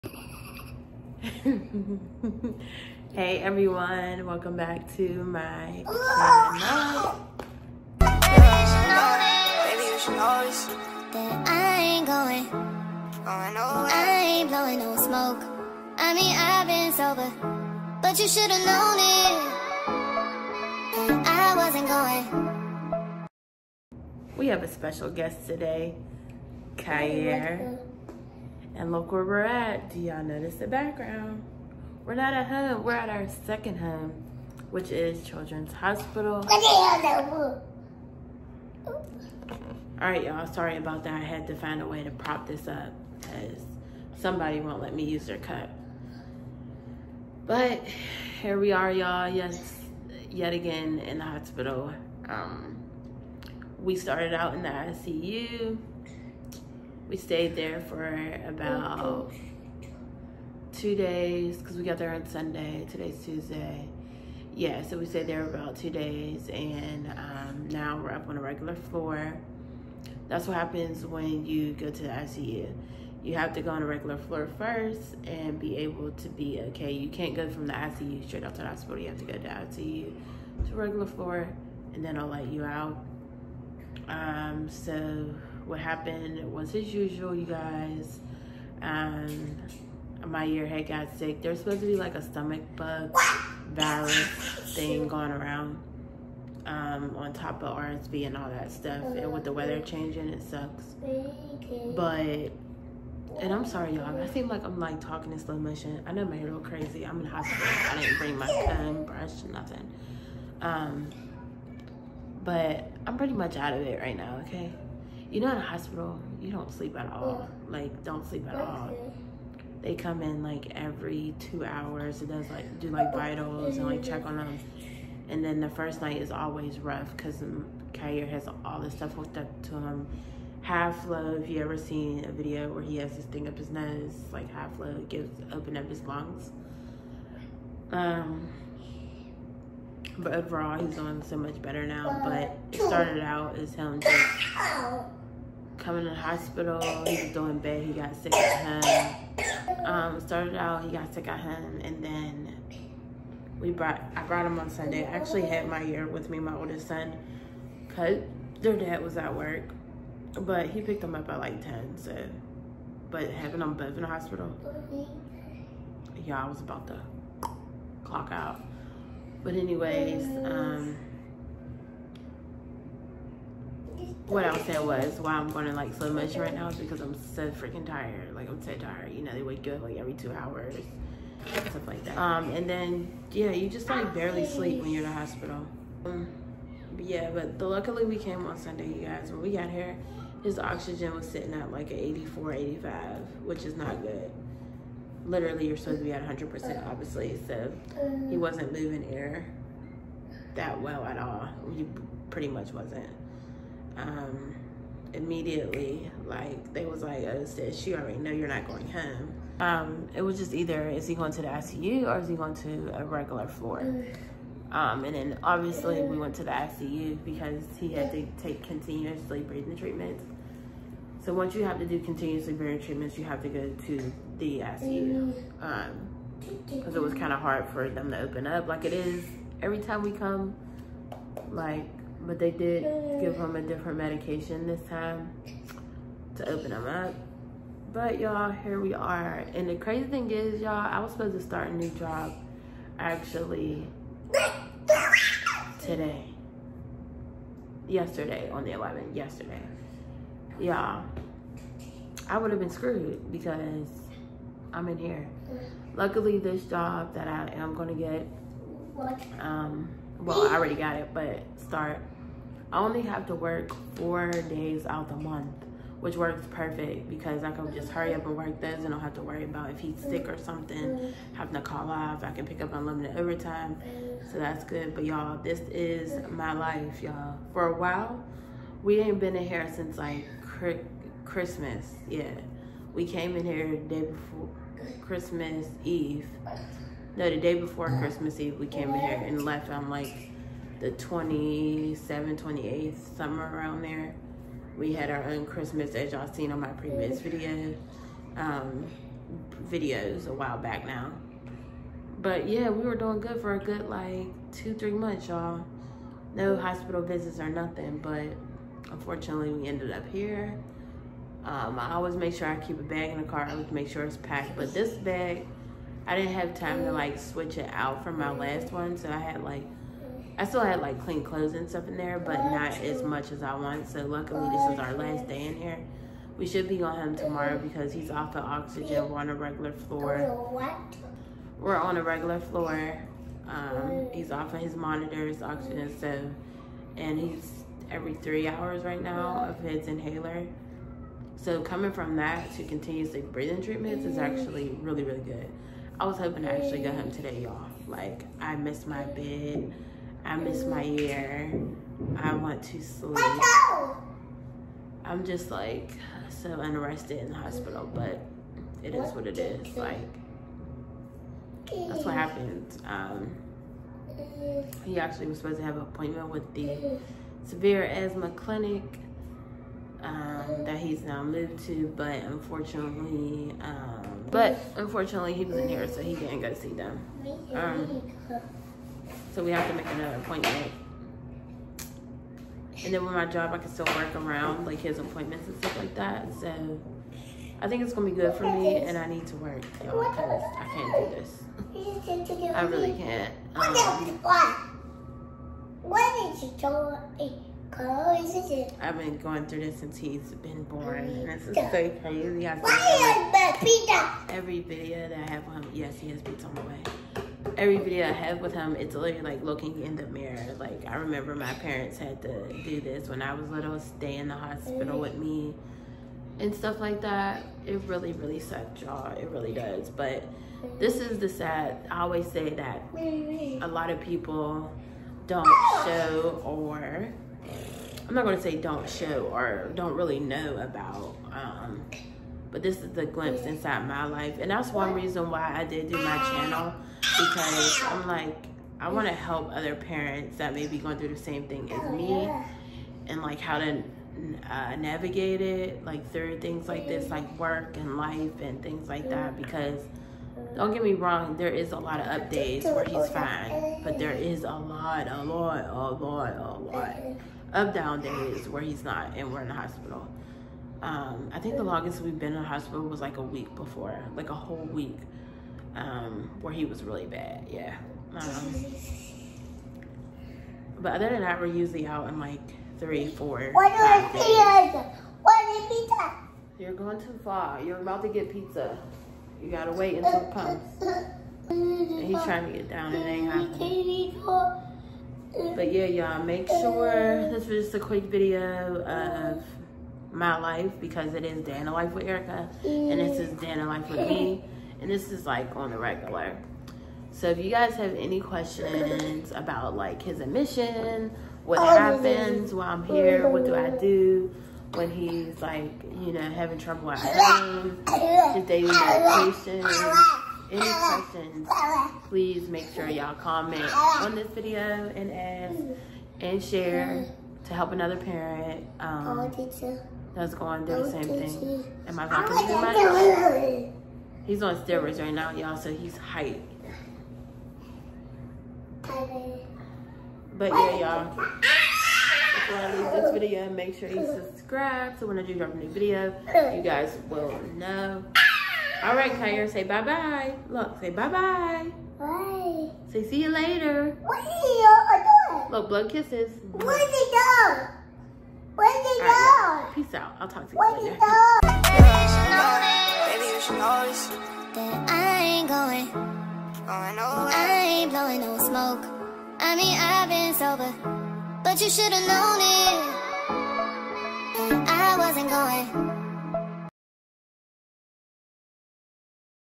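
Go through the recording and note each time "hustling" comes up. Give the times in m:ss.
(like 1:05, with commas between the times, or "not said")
not said.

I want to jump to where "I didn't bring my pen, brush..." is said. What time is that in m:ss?
1:47.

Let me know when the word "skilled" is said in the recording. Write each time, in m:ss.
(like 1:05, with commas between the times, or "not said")
not said.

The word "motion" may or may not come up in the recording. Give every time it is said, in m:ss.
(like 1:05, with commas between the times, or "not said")
1:45.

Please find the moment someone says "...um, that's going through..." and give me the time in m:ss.
8:38.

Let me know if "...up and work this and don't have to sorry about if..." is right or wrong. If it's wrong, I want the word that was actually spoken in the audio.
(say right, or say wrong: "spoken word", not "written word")
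wrong: "worry", not "sorry".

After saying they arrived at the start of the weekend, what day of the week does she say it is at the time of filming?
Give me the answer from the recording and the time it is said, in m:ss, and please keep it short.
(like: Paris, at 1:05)
Tuesday, at 1:03.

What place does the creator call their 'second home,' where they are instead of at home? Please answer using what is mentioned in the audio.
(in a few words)
Children's Hospital.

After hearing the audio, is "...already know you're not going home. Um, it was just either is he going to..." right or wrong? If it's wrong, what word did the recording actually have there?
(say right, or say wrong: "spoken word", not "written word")
right.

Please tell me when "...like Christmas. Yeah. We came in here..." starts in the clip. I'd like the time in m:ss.
4:39.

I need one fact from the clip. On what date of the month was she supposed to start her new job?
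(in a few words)
11th.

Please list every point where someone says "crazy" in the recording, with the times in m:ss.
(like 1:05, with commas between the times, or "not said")
1:46, 3:59, 6:41.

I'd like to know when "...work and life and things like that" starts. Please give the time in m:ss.
7:27.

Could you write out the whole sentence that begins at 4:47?
No, the day before Christmas Eve, we came in here and left.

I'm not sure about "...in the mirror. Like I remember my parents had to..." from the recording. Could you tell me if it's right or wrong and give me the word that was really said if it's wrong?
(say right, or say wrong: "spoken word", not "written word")
right.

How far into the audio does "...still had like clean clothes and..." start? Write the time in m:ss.
5:20.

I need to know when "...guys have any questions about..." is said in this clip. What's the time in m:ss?
8:17.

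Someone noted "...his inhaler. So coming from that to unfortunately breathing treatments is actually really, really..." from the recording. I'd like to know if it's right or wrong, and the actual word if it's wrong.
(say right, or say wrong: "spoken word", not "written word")
wrong: "continuously", not "unfortunately".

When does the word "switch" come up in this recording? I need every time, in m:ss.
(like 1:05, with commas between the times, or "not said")
5:17.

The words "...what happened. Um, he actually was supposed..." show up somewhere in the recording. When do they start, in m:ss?
6:02.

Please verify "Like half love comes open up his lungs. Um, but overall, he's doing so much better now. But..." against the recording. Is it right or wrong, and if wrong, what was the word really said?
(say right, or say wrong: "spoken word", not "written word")
wrong: "gives", not "comes".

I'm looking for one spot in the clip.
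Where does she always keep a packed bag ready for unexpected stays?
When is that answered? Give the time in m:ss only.
5:13.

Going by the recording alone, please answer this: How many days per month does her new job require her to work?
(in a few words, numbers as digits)
4.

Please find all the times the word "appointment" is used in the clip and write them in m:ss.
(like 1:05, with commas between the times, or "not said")
6:05, 6:20, 6:24.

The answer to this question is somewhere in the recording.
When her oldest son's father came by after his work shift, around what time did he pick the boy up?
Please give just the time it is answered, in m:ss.
2:41.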